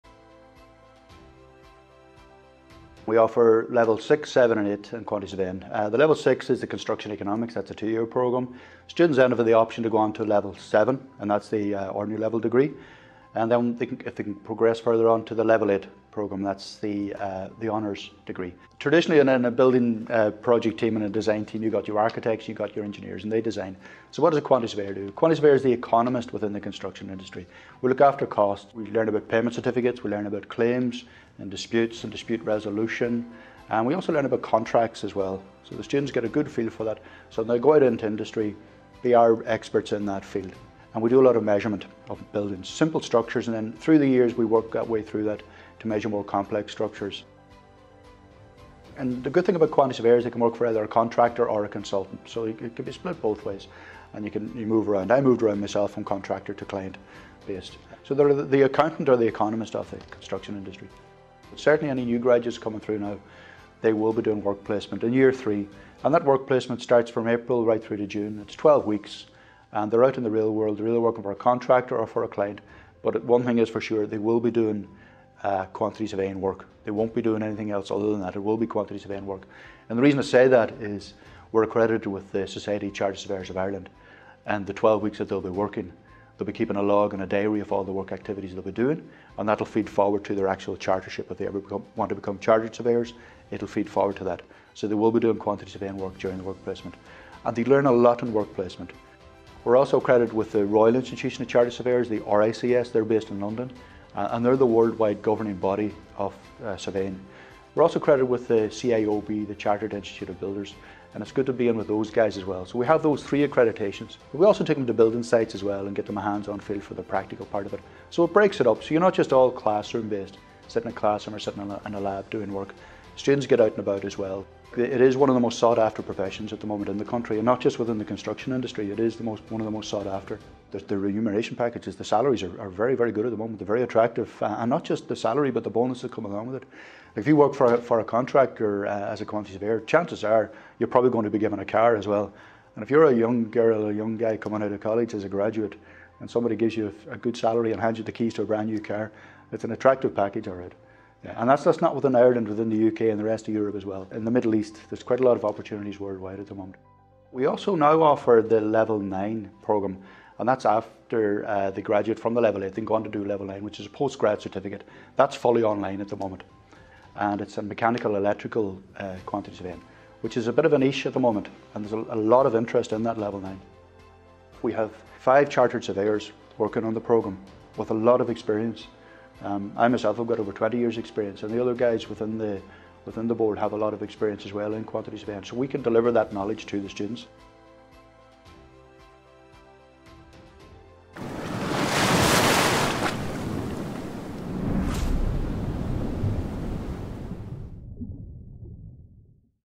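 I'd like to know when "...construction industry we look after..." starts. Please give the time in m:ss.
0:26.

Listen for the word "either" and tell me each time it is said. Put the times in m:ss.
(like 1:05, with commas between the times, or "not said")
0:50, 1:10.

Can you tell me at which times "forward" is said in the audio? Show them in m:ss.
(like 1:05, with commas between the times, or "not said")
1:29, 1:33.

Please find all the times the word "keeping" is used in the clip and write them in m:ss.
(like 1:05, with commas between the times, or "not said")
1:26.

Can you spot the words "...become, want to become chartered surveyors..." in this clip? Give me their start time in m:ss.
1:31.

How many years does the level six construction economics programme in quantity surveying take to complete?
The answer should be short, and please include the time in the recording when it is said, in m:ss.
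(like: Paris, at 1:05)
2 years, at 0:07.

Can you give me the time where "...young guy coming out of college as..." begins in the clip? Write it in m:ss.
2:23.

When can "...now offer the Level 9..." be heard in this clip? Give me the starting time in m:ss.
2:37.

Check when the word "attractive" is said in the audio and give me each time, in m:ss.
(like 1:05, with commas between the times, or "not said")
2:13, 2:29.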